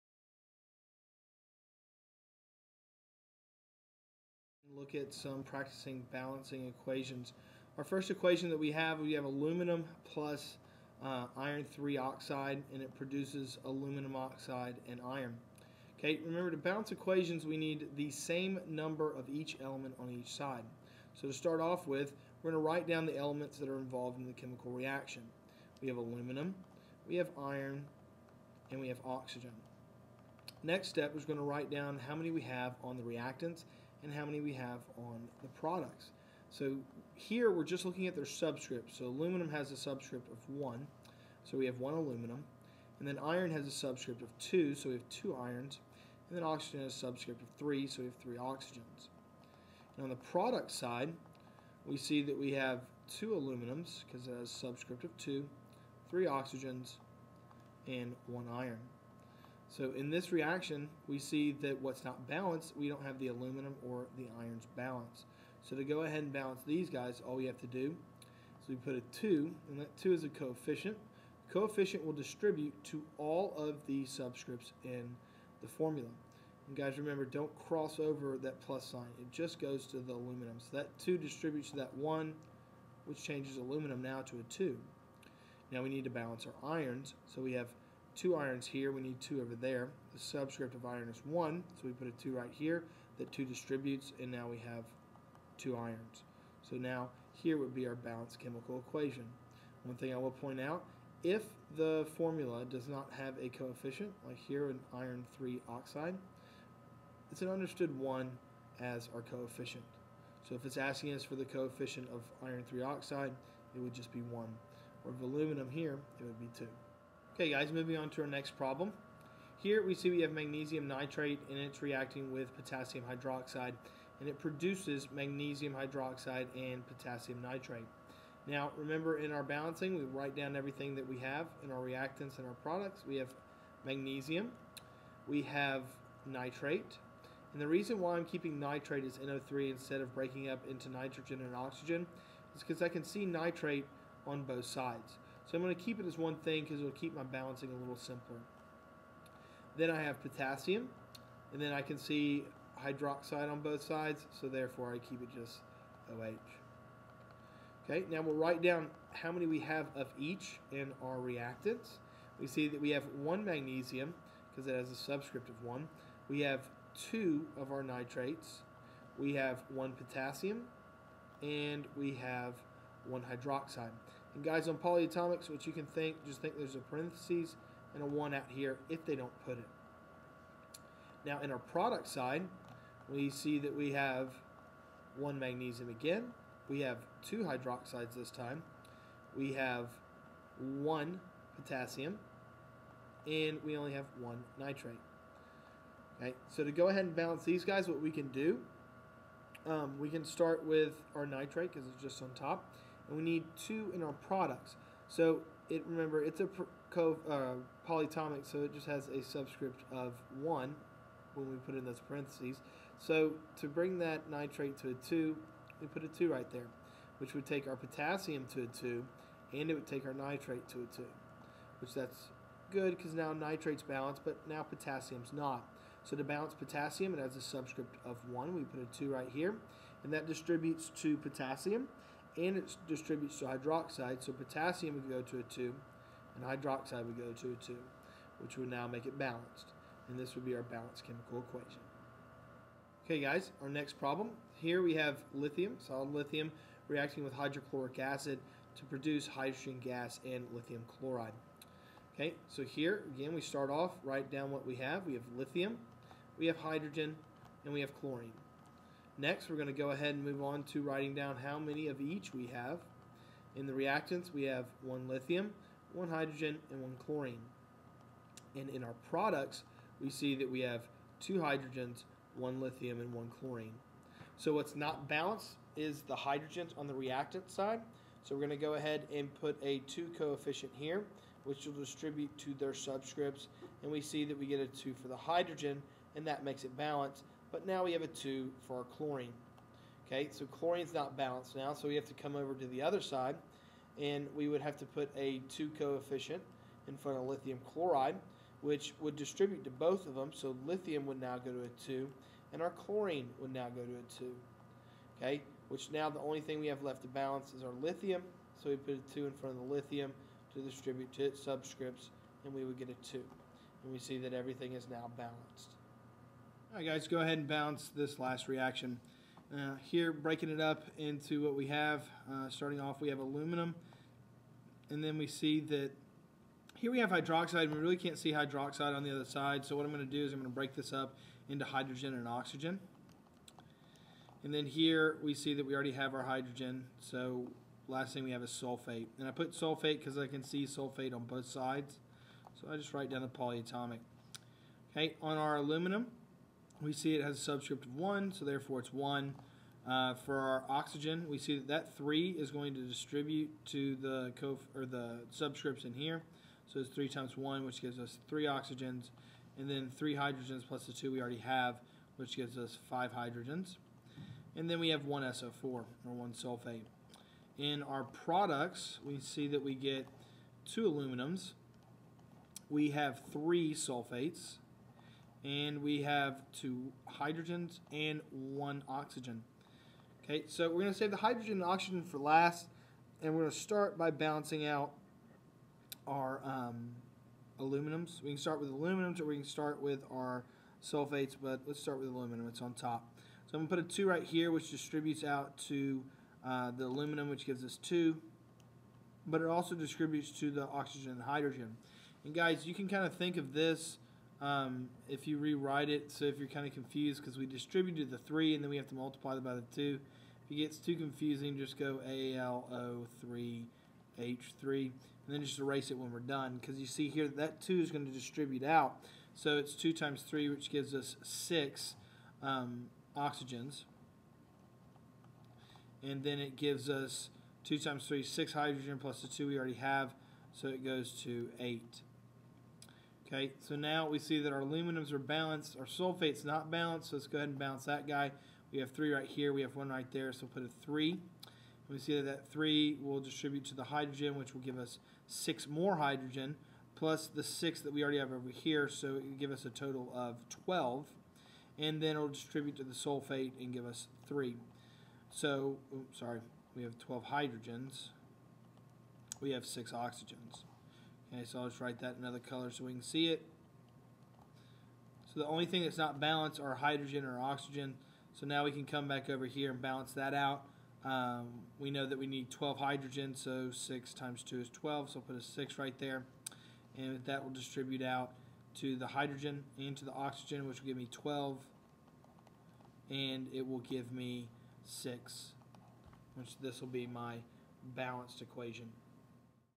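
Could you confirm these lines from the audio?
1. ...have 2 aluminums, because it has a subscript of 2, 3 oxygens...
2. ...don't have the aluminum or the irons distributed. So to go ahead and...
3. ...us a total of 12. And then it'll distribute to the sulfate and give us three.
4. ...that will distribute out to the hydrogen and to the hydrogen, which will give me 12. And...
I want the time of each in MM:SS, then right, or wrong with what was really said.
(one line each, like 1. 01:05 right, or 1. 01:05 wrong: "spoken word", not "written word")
1. 00:52 right
2. 01:02 wrong: "balanced", not "distributed"
3. 07:29 right
4. 07:57 wrong: "oxygen", not "hydrogen".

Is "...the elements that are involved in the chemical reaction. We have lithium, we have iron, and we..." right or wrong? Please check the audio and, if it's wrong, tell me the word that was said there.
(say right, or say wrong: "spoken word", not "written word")
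wrong: "aluminum", not "lithium".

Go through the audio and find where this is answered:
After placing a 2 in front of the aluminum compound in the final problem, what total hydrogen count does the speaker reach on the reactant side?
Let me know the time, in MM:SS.
07:10.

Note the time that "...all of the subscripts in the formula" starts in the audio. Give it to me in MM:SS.
01:13.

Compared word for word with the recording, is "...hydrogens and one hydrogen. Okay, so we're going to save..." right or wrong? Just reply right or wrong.
wrong.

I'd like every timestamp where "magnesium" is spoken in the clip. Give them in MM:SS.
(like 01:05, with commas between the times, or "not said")
02:00, 02:05, 02:13, 02:43, 03:05.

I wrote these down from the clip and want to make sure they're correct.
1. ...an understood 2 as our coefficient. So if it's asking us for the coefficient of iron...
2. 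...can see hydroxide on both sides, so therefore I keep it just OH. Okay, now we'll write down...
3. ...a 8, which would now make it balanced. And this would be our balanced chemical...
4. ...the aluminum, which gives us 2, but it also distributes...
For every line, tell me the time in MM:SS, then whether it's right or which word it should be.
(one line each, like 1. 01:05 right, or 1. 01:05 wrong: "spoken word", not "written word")
1. 01:47 wrong: "1", not "2"
2. 02:31 right
3. 03:57 wrong: "2", not "8"
4. 06:36 right.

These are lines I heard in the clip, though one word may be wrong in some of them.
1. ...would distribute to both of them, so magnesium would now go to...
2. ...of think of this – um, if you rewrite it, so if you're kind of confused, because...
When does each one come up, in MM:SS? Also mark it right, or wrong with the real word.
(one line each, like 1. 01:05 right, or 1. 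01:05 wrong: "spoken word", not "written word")
1. 04:58 wrong: "lithium", not "magnesium"
2. 06:43 right.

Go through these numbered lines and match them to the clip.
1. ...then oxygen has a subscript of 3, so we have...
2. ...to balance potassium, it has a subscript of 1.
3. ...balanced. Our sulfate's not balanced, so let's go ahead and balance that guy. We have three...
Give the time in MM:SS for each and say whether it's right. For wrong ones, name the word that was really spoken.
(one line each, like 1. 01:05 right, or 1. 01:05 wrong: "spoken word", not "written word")
1. 00:46 right
2. 03:46 right
3. 07:15 right.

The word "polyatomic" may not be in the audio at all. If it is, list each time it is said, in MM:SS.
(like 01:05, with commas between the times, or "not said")
02:54, 03:27, 05:43.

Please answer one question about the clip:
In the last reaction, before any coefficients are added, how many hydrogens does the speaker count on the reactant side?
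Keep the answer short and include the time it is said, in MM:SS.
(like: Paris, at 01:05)
5, at 06:02.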